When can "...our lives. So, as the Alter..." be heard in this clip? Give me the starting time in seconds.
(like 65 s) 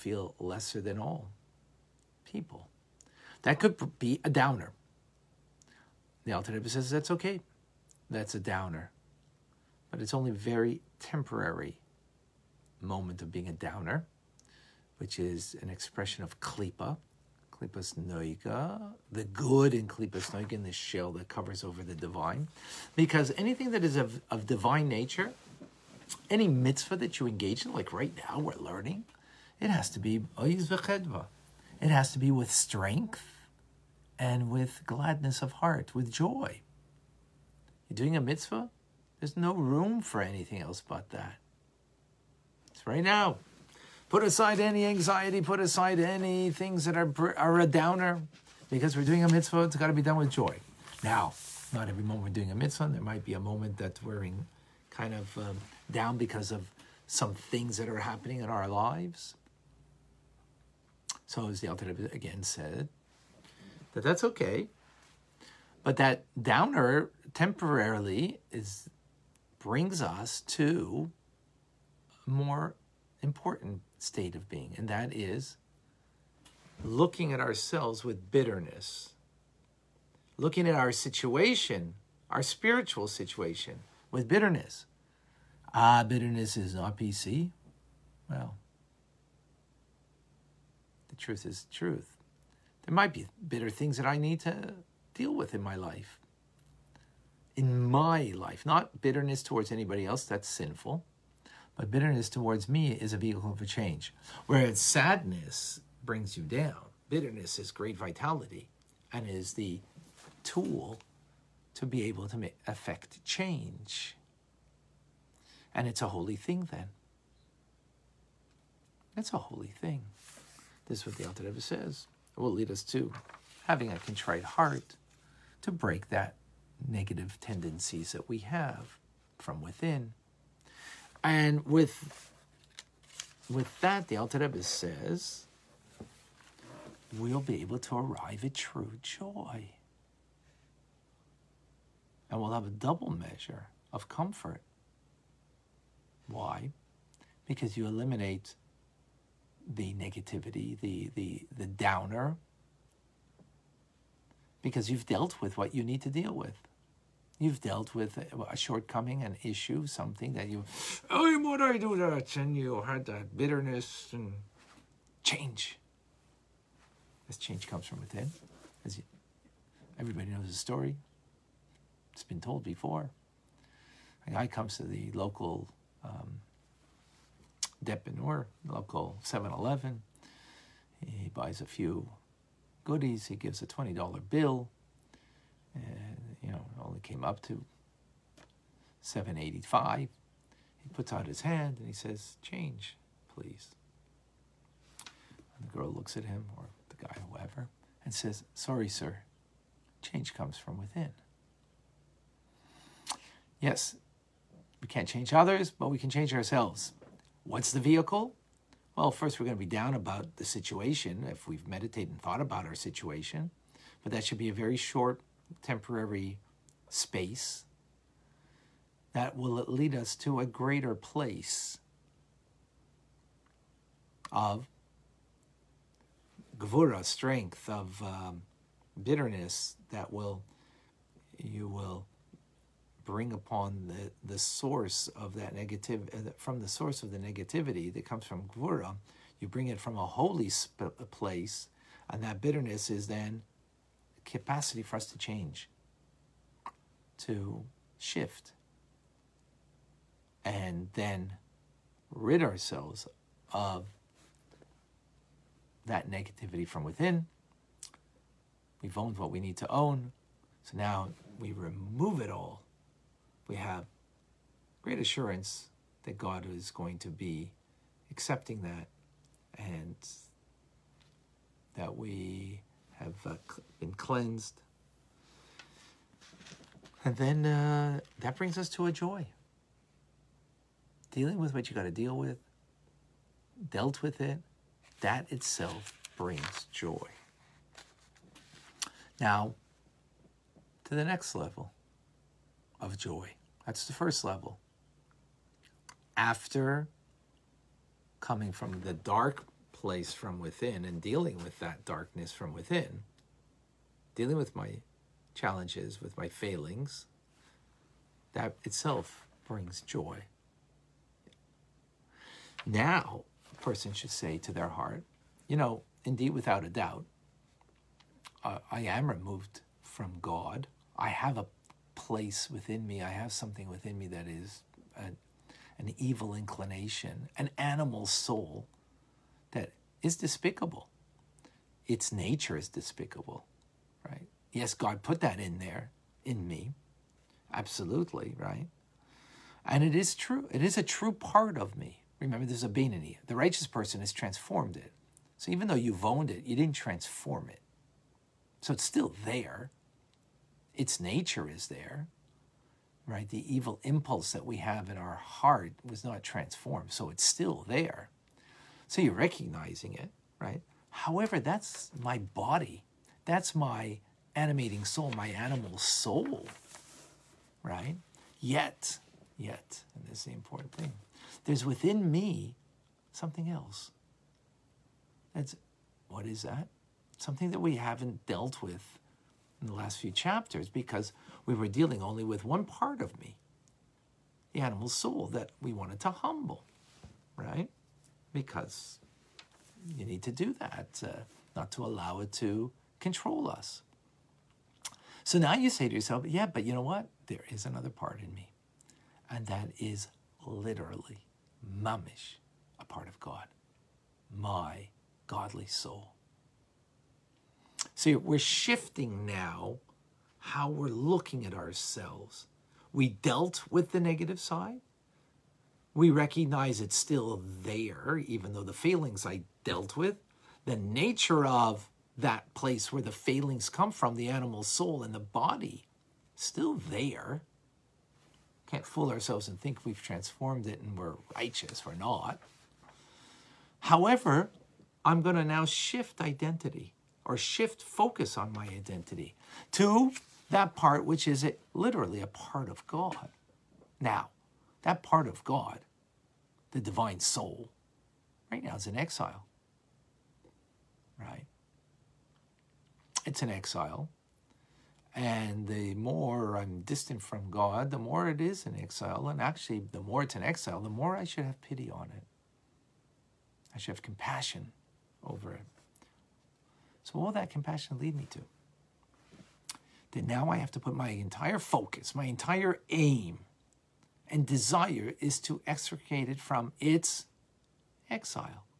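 58 s.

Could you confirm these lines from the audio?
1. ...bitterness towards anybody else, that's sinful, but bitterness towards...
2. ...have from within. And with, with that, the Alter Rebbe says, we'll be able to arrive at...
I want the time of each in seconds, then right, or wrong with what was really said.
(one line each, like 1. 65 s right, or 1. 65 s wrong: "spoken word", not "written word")
1. 99 s right
2. 128 s right.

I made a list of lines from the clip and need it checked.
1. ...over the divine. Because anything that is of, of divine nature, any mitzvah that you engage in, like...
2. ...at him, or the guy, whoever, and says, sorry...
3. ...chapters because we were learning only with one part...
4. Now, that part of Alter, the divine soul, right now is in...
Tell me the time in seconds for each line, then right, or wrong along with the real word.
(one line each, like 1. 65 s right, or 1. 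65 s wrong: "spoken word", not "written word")
1. 21 s right
2. 196 s right
3. 380 s wrong: "dealing", not "learning"
4. 443 s wrong: "God", not "Alter".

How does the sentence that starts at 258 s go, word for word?
We've owned what we need to own.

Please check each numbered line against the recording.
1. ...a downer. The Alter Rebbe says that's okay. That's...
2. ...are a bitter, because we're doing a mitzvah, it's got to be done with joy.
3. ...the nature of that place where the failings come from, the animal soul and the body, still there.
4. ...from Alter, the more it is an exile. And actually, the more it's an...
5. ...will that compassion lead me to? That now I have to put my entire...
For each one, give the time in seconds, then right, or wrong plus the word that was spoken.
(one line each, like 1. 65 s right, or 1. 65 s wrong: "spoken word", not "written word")
1. 4 s right
2. 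47 s wrong: "downer", not "bitter"
3. 420 s right
4. 457 s wrong: "God", not "Alter"
5. 467 s right.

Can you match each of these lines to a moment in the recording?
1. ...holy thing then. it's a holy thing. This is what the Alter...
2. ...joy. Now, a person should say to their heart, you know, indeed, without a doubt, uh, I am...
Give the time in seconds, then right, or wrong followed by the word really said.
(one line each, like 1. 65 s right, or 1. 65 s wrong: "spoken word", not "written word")
1. 116 s right
2. 309 s right.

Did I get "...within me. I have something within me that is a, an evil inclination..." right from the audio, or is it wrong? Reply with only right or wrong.
right.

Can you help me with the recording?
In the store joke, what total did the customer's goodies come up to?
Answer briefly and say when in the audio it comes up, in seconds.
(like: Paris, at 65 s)
785, at 189 s.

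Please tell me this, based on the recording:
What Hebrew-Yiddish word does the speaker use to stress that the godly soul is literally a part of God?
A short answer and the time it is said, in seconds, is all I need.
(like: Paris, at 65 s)
mamish, at 401 s.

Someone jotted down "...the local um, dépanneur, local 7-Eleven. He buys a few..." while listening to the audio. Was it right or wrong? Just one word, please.
right.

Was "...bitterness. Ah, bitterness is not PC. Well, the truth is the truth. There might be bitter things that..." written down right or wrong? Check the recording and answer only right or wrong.
right.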